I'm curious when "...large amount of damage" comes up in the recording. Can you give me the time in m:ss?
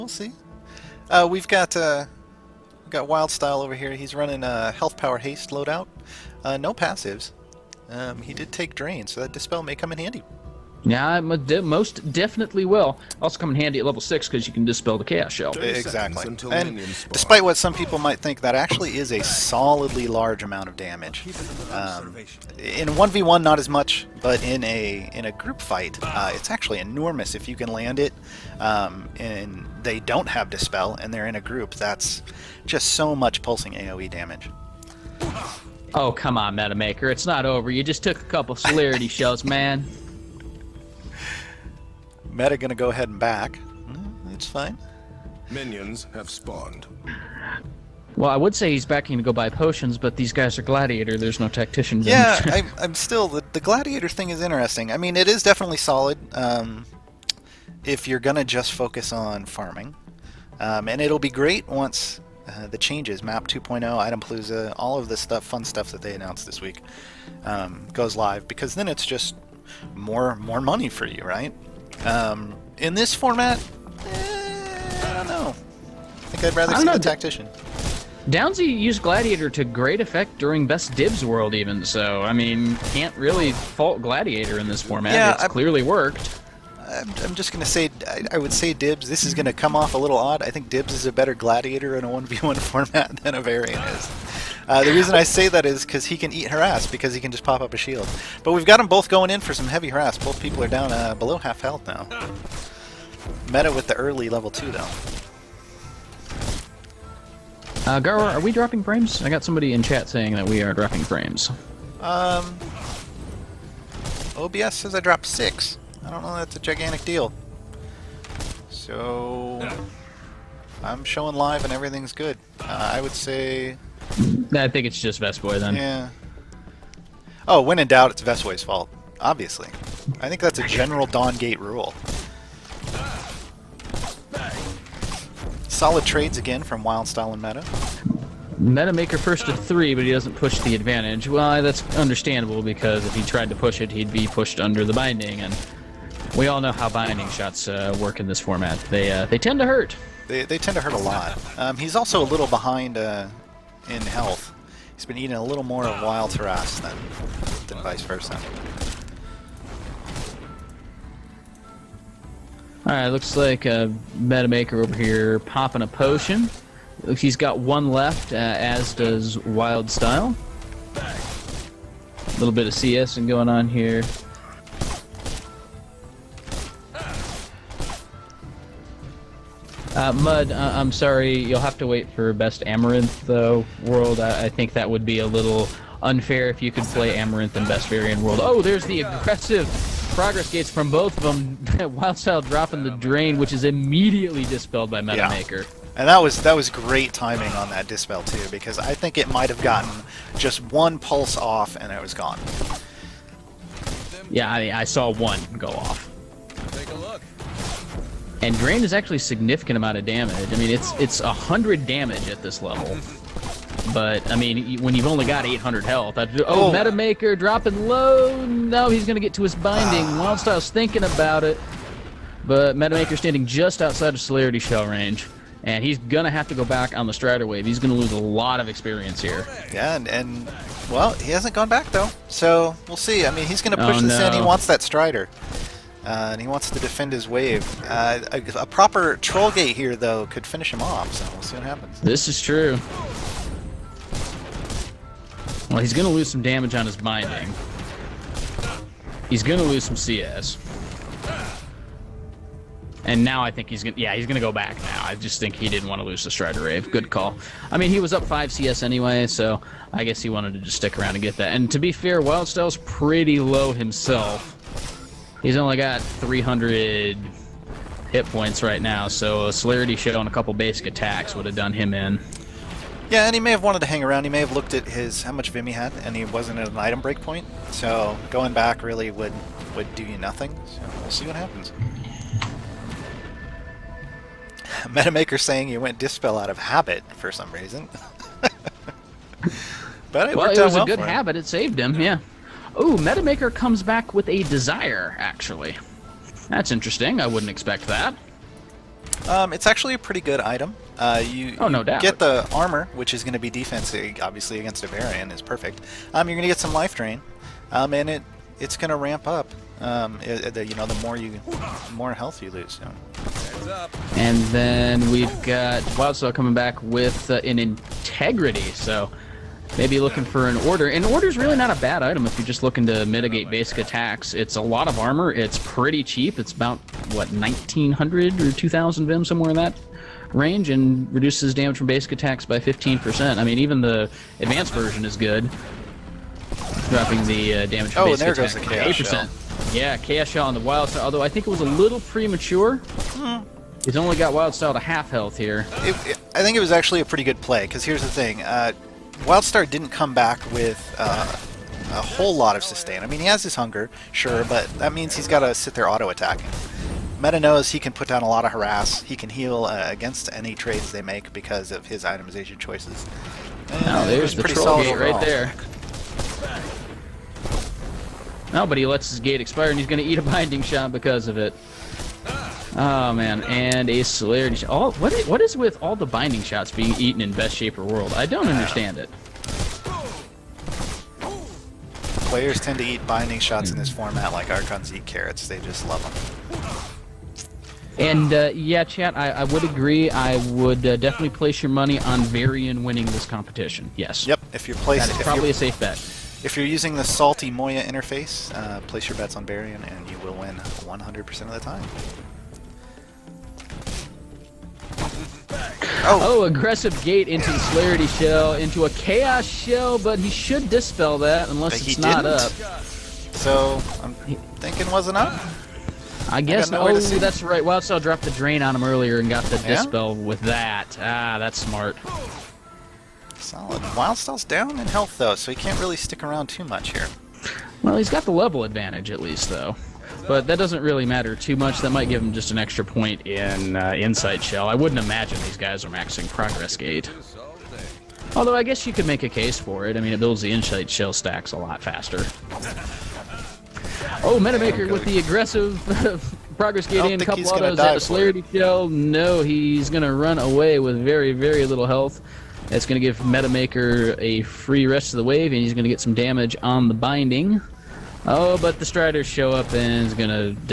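0:20.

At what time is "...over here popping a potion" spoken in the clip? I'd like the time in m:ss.
2:44.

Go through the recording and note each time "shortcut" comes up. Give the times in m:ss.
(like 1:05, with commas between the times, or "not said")
not said.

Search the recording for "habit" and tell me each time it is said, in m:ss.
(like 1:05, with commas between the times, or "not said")
4:46, 4:50.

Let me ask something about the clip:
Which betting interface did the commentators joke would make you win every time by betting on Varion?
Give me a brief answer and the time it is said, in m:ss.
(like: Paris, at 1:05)
salty Moya, at 6:37.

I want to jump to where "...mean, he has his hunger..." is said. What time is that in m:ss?
5:53.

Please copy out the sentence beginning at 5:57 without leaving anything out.
Meta knows he can put down a lot of harass.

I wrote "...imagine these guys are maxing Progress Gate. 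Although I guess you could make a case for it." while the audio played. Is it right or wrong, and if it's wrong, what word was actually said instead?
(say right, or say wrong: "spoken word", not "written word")
right.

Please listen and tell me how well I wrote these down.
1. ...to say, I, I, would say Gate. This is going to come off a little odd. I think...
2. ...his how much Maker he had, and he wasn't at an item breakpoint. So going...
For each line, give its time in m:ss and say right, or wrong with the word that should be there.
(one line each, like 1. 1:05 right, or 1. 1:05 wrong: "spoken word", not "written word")
1. 1:27 wrong: "Dibs", not "Gate"
2. 4:34 wrong: "Vim", not "Maker".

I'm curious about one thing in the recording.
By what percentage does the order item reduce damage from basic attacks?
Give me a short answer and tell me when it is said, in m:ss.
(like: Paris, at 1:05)
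15%, at 5:32.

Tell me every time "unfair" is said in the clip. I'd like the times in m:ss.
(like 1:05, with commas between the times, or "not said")
3:06.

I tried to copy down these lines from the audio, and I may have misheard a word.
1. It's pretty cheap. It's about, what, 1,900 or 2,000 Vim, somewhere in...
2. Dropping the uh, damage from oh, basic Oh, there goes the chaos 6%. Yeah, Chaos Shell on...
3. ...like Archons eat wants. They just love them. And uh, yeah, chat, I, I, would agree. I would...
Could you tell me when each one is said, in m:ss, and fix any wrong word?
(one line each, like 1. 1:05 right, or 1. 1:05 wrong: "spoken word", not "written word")
1. 5:25 right
2. 5:36 wrong: "8", not "6"
3. 6:24 wrong: "carrots", not "wants".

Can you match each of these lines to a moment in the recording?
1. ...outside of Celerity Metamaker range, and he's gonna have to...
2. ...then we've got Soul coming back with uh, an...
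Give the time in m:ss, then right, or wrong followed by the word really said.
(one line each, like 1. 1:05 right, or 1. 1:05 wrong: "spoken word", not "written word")
1. 3:43 wrong: "Shell", not "Metamaker"
2. 5:14 right.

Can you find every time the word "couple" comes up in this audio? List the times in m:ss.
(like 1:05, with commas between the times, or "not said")
0:38, 4:30, 7:27.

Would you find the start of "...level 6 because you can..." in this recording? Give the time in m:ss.
0:13.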